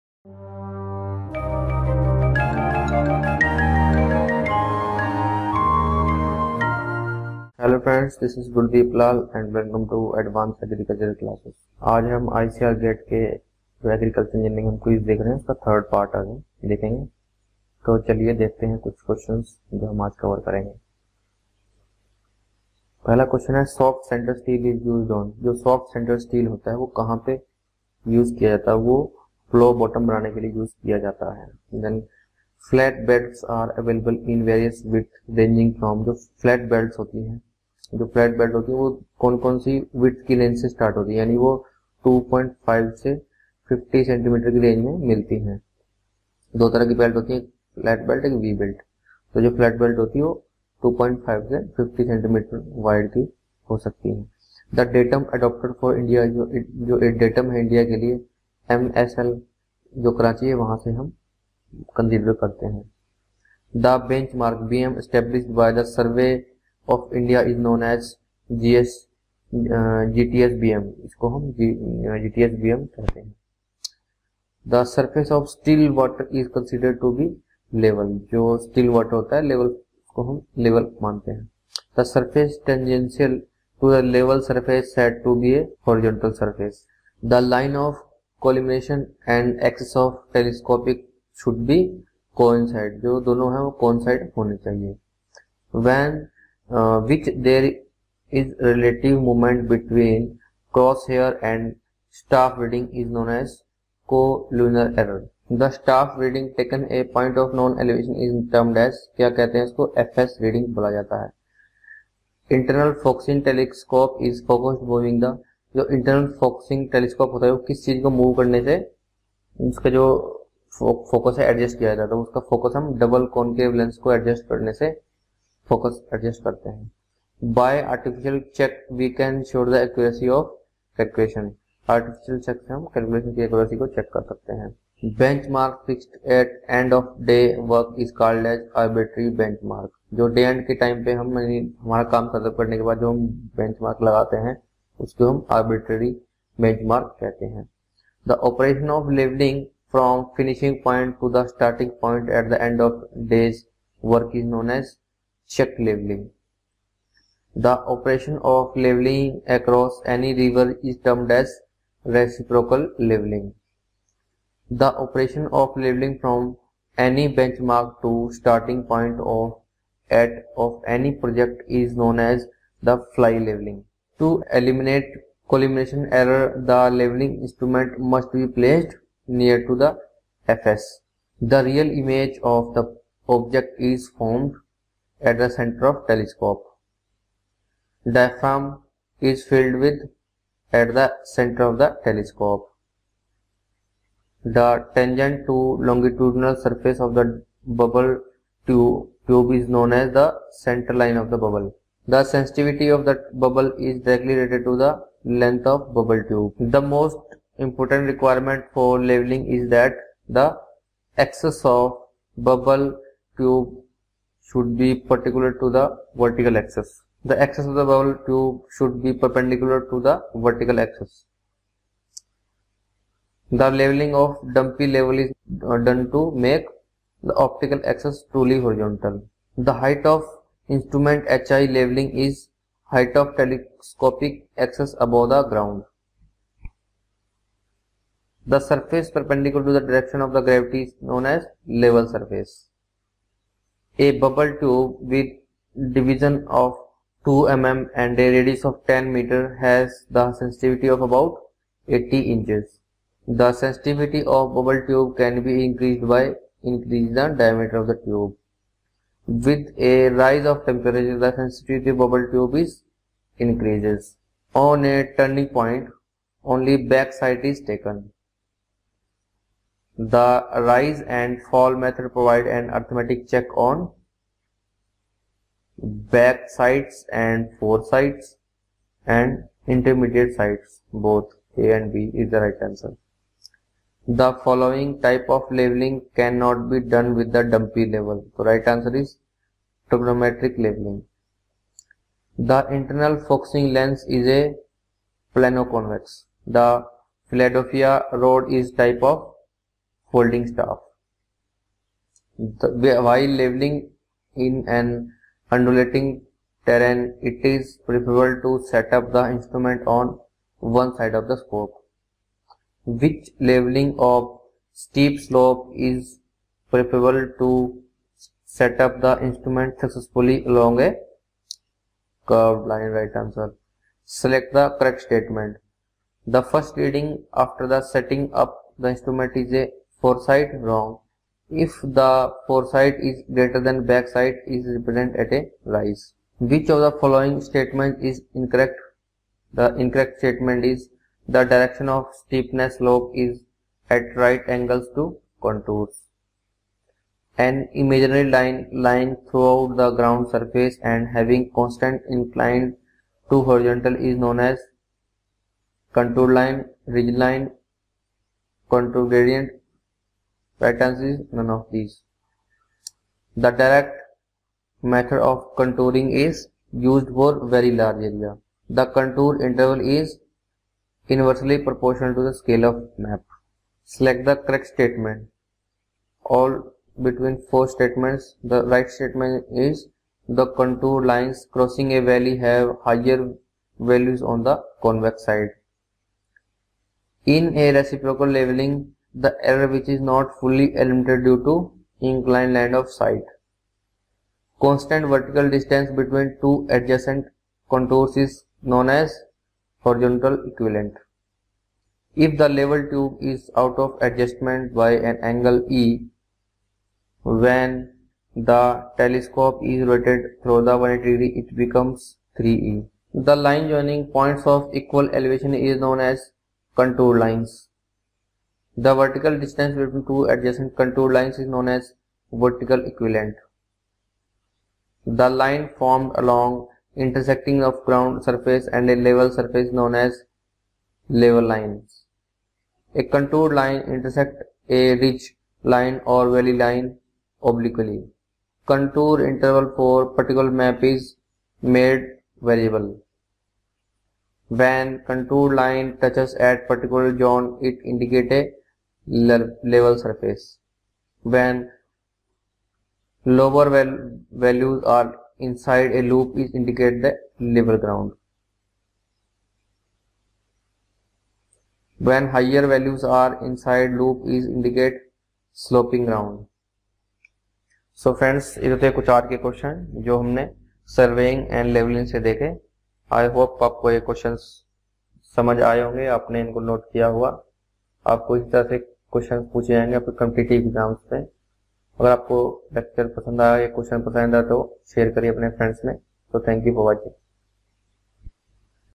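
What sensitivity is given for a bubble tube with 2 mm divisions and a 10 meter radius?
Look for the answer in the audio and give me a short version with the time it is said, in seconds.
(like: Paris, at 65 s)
80 inches, at 251 s.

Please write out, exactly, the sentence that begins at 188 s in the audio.
Diaphragm is filled with at the center of the telescope.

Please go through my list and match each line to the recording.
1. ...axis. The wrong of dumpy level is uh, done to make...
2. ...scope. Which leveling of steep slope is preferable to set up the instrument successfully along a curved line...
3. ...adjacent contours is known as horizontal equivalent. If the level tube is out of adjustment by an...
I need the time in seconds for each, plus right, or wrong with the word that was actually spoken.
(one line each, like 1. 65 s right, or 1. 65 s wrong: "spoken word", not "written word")
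1. 220 s wrong: "leveling", not "wrong"
2. 311 s right
3. 396 s right.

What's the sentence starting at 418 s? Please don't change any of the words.
The vertical distance between two adjacent contour lines is known as vertical equivalent.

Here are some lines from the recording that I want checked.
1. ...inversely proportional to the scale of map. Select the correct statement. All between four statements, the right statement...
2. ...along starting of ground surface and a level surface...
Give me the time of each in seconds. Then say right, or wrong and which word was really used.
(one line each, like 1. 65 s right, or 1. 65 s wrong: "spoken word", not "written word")
1. 371 s right
2. 426 s wrong: "intersecting", not "starting".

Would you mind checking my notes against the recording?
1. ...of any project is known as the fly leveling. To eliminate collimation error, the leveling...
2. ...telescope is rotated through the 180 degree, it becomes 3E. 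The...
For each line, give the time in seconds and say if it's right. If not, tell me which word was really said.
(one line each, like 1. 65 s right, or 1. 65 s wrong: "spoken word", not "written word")
1. 170 s right
2. 408 s right.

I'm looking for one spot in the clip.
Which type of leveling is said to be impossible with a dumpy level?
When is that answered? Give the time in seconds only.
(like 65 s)
289 s.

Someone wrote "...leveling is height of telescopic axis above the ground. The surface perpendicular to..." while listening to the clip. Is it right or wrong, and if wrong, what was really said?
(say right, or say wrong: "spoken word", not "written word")
right.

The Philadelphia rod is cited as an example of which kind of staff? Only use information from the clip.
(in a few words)
Holding staff.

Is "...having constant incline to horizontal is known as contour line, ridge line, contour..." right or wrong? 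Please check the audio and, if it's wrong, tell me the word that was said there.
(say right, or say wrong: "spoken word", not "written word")
right.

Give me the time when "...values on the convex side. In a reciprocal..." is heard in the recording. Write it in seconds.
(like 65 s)
383 s.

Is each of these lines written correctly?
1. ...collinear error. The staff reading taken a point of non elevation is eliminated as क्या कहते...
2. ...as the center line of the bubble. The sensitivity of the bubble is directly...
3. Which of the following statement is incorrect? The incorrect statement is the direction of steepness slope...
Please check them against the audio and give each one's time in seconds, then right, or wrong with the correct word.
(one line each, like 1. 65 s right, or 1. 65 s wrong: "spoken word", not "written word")
1. 104 s wrong: "termed", not "eliminated"
2. 199 s right
3. 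336 s right.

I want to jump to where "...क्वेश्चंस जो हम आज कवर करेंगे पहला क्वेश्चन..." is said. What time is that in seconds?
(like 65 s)
19 s.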